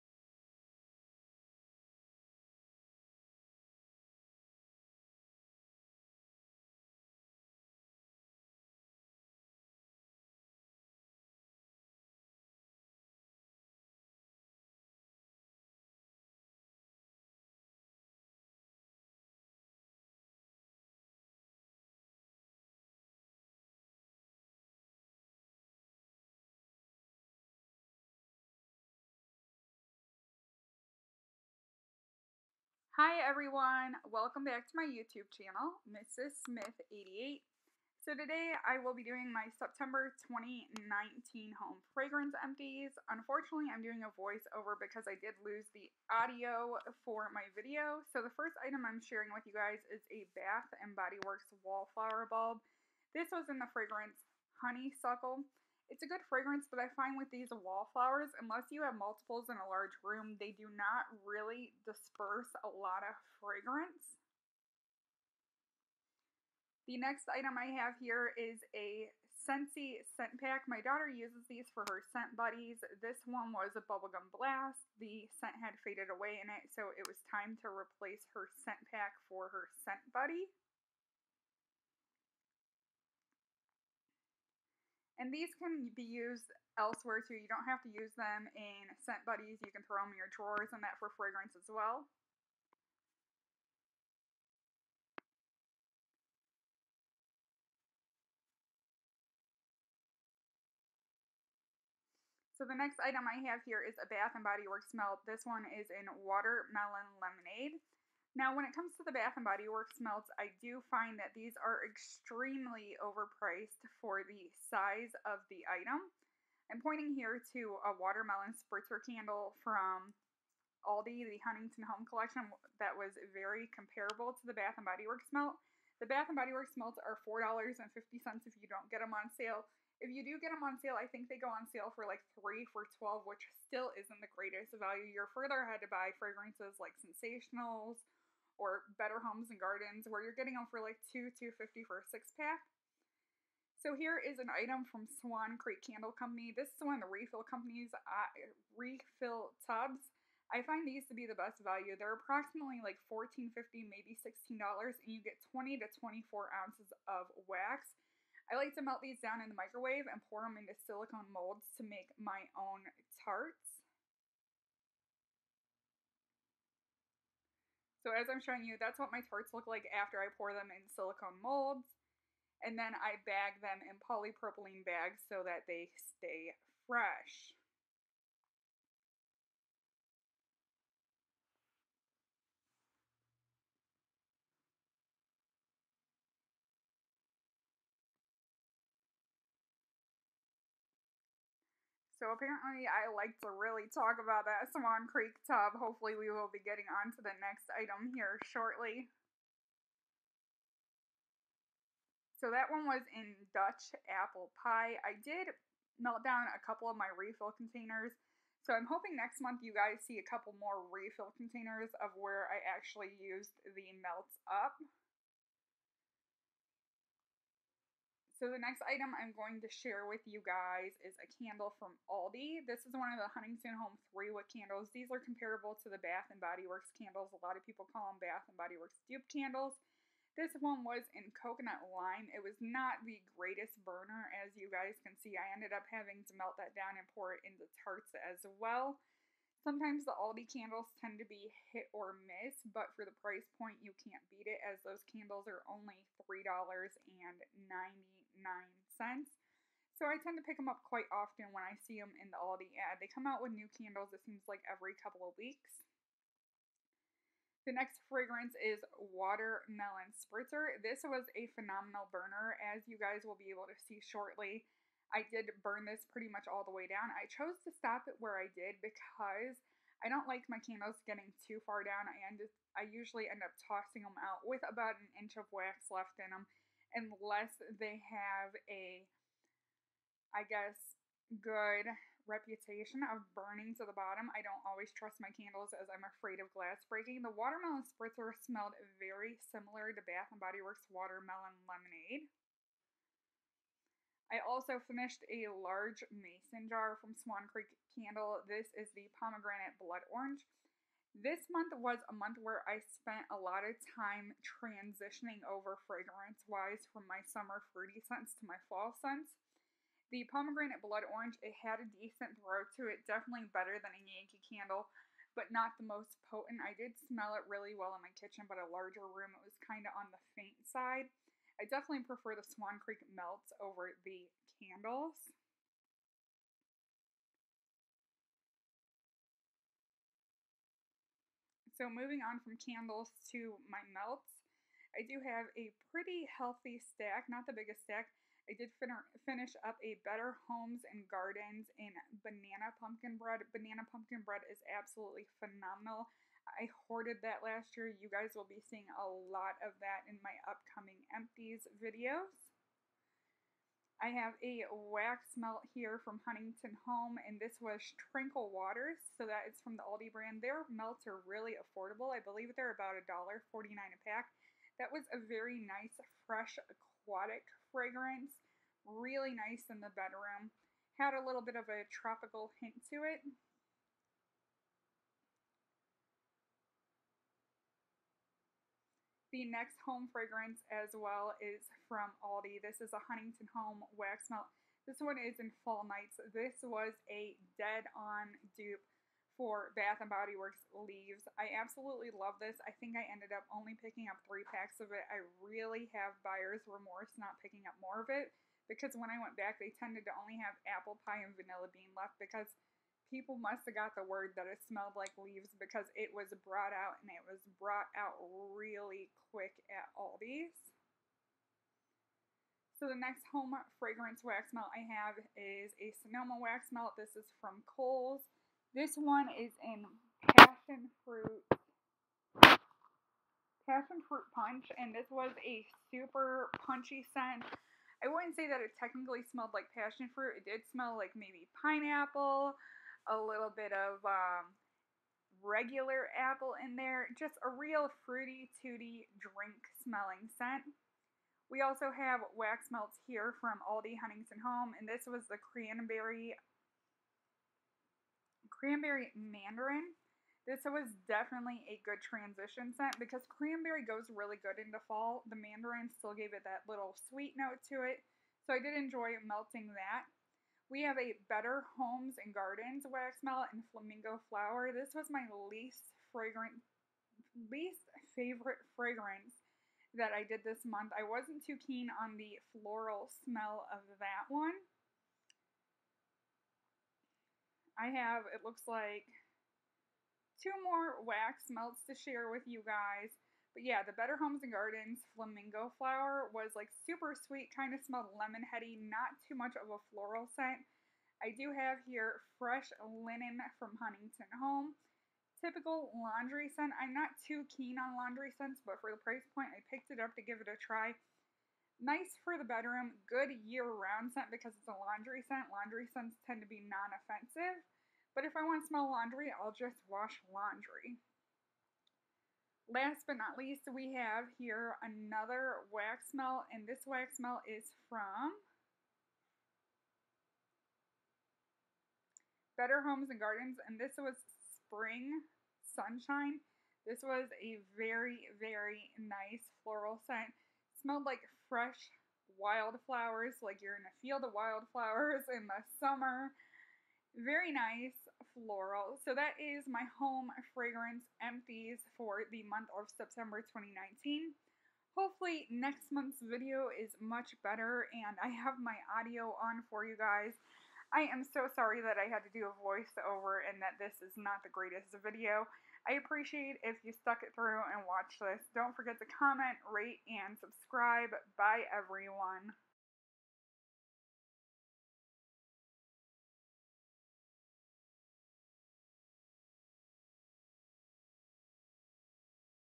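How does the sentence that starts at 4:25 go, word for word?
I did burn this pretty much all the way down.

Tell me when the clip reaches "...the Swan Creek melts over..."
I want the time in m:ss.
5:22.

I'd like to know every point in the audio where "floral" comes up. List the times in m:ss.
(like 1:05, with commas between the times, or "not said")
7:52, 8:09, 8:49, 8:58.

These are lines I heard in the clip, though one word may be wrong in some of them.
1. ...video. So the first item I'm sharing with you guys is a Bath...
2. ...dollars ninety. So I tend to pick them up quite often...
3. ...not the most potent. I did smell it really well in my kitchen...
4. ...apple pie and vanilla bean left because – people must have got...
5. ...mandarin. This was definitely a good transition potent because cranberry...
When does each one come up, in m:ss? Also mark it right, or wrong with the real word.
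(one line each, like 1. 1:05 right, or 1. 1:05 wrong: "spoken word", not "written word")
1. 0:47 right
2. 4:06 right
3. 5:15 right
4. 6:40 right
5. 7:29 wrong: "scent", not "potent".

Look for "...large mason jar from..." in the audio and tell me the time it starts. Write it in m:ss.
4:55.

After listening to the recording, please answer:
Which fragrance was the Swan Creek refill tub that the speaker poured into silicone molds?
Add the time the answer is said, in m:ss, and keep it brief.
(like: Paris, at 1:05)
Dutch apple pie, at 3:23.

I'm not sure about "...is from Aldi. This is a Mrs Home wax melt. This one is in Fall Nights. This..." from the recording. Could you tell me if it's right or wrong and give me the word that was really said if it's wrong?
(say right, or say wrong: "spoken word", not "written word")
wrong: "Huntington", not "Mrs".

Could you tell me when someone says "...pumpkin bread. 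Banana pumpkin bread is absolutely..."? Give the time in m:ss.
5:42.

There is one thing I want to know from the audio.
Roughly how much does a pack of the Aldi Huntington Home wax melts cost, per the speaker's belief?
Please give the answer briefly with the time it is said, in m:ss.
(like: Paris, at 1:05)
$1.49, at 6:02.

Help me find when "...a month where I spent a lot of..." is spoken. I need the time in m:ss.
5:02.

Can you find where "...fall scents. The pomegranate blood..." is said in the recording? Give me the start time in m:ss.
5:08.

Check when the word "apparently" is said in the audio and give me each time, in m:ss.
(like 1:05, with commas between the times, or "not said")
3:12.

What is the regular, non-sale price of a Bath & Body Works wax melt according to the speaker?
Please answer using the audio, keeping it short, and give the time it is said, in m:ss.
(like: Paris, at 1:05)
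$4.50, at 2:07.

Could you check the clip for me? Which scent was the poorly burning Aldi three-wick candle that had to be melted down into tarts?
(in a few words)
Coconut lime.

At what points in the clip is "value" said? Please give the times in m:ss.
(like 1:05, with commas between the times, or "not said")
2:14, 2:31.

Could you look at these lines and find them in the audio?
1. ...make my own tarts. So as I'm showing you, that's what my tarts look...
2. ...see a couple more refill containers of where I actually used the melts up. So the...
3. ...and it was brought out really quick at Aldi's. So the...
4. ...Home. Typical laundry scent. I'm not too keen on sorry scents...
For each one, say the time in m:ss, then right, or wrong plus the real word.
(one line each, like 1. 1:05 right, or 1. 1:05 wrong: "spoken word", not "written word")
1. 2:41 right
2. 3:30 right
3. 6:47 right
4. 8:14 wrong: "laundry", not "sorry".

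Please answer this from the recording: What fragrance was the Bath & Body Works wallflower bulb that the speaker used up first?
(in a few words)
Honeysuckle.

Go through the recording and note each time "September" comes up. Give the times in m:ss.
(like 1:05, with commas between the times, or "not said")
0:39, 9:02.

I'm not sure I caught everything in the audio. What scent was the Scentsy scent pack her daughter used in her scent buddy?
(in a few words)
Bubblegum Blast.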